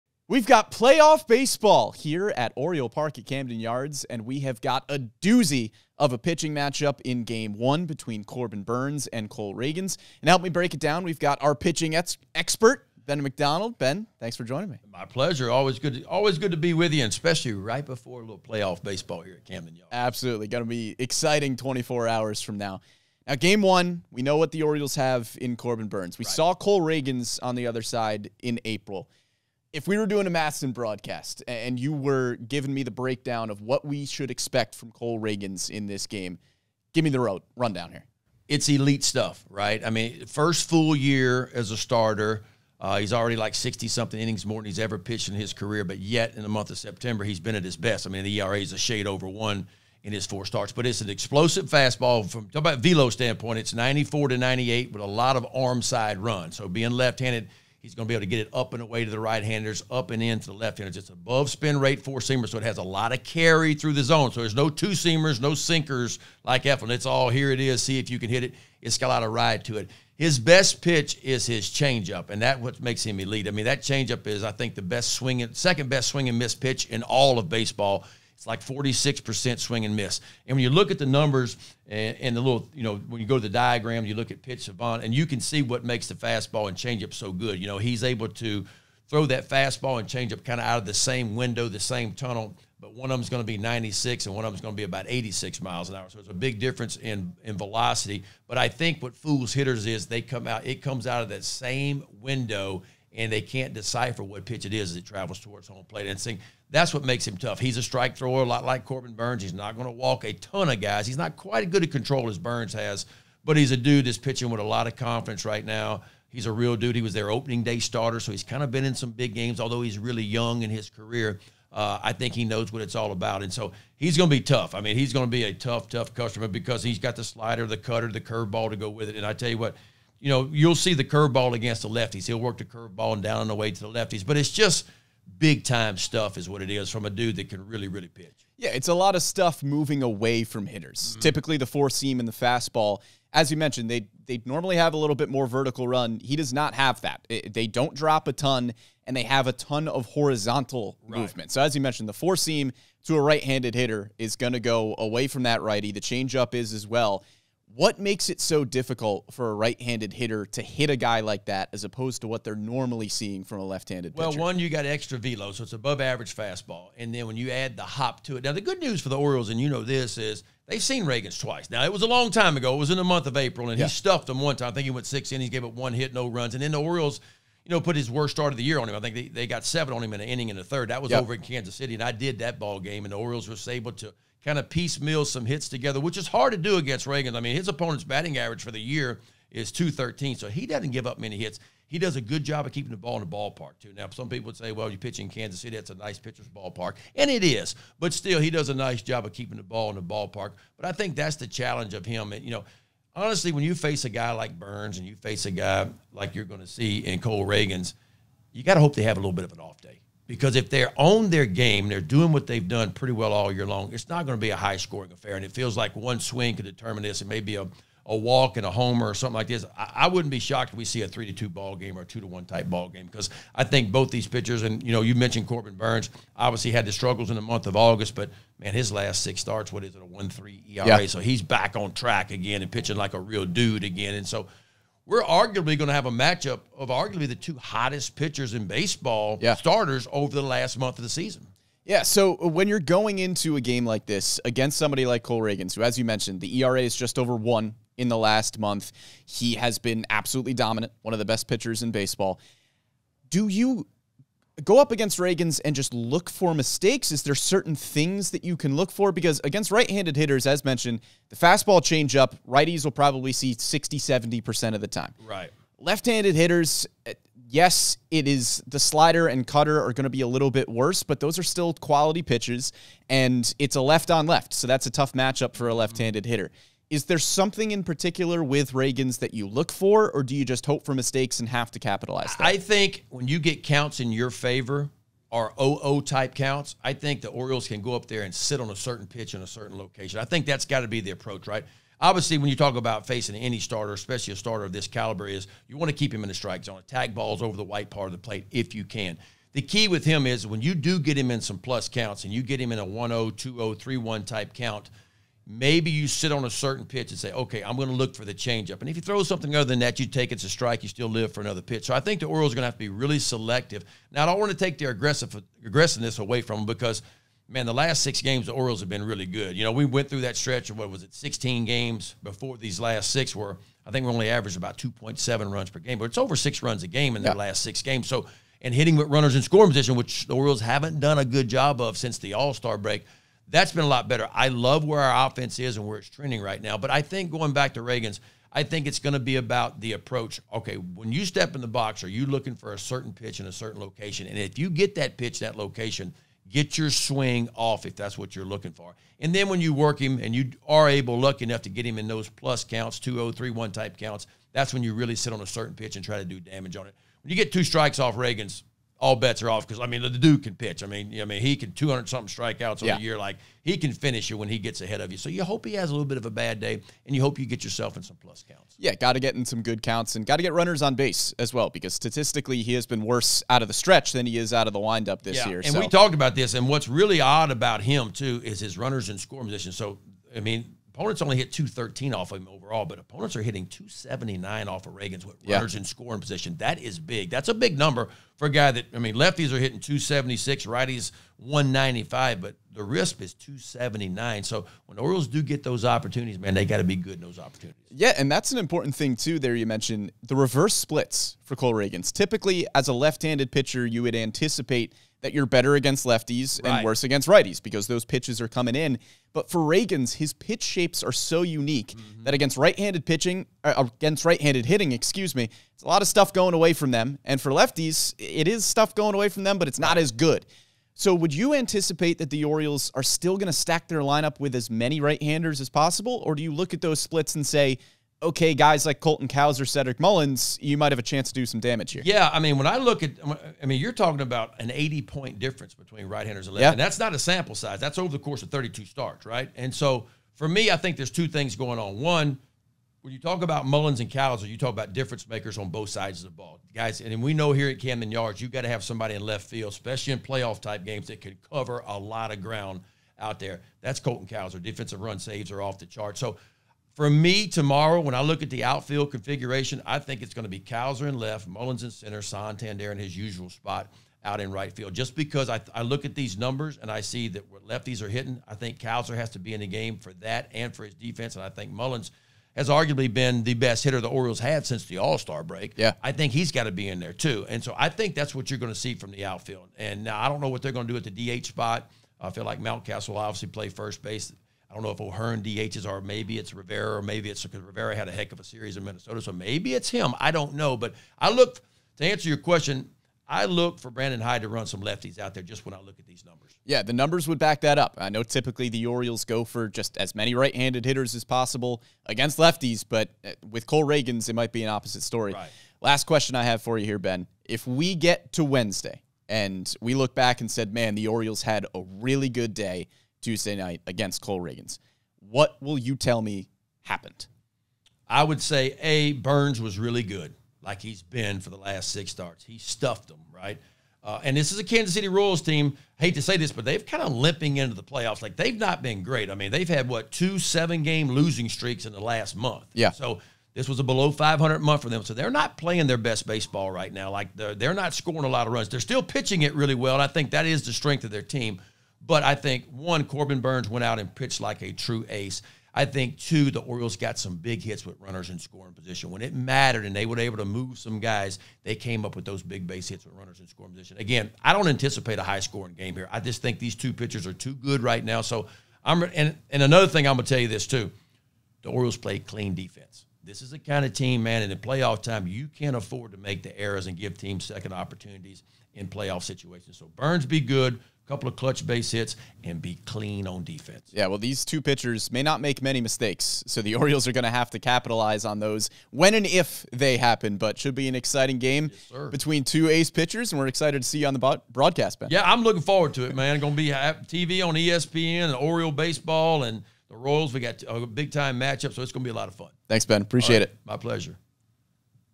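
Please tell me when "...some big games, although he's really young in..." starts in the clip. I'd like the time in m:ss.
1:58.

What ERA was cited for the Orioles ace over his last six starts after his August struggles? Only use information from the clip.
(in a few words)
1.3.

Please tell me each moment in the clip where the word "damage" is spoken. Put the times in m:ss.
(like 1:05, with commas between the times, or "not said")
5:56, 7:11.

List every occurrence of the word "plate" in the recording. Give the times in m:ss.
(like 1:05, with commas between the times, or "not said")
1:45, 4:58.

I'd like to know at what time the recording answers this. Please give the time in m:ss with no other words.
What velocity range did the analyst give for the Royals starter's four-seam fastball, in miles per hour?
0:53.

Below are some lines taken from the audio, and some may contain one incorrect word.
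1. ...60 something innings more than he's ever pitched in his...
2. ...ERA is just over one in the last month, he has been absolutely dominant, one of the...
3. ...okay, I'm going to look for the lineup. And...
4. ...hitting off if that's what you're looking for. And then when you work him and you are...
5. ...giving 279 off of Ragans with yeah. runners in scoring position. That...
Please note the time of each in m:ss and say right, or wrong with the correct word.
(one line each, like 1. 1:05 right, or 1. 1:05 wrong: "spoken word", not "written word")
1. 0:43 right
2. 4:06 right
3. 5:07 wrong: "changeup", not "lineup"
4. 5:46 wrong: "swing", not "hitting"
5. 6:23 wrong: "hitting", not "giving".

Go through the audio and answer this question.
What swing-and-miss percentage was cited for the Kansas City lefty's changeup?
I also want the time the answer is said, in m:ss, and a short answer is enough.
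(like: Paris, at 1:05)
46%, at 1:18.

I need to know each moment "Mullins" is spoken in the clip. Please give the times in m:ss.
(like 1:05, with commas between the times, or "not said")
7:09, 7:23, 7:41, 7:51.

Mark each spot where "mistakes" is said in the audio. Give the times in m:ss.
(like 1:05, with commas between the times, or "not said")
4:16, 4:40, 9:35.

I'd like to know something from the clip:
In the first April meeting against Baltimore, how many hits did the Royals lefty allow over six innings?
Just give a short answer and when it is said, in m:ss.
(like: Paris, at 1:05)
1, at 2:55.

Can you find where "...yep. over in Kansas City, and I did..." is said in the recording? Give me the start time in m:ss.
3:01.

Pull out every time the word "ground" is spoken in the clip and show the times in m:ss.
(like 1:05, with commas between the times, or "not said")
7:32.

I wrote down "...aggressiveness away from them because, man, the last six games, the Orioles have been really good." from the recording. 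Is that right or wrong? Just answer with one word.
right.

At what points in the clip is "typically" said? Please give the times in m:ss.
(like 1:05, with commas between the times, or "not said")
2:21, 6:42, 8:18.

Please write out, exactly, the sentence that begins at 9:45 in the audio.
Yeah, I'm looking forward to it, man.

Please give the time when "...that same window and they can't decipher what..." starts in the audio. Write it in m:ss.
1:41.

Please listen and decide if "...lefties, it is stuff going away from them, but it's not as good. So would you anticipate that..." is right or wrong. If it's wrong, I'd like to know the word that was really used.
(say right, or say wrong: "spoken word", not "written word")
right.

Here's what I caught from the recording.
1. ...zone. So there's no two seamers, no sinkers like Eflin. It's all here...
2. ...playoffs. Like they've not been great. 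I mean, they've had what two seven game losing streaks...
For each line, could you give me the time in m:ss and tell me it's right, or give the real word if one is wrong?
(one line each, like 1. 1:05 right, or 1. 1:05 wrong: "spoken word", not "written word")
1. 1:04 right
2. 8:47 right.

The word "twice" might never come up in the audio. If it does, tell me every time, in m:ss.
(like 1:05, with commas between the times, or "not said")
2:51.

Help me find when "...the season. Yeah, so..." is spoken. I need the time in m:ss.
4:01.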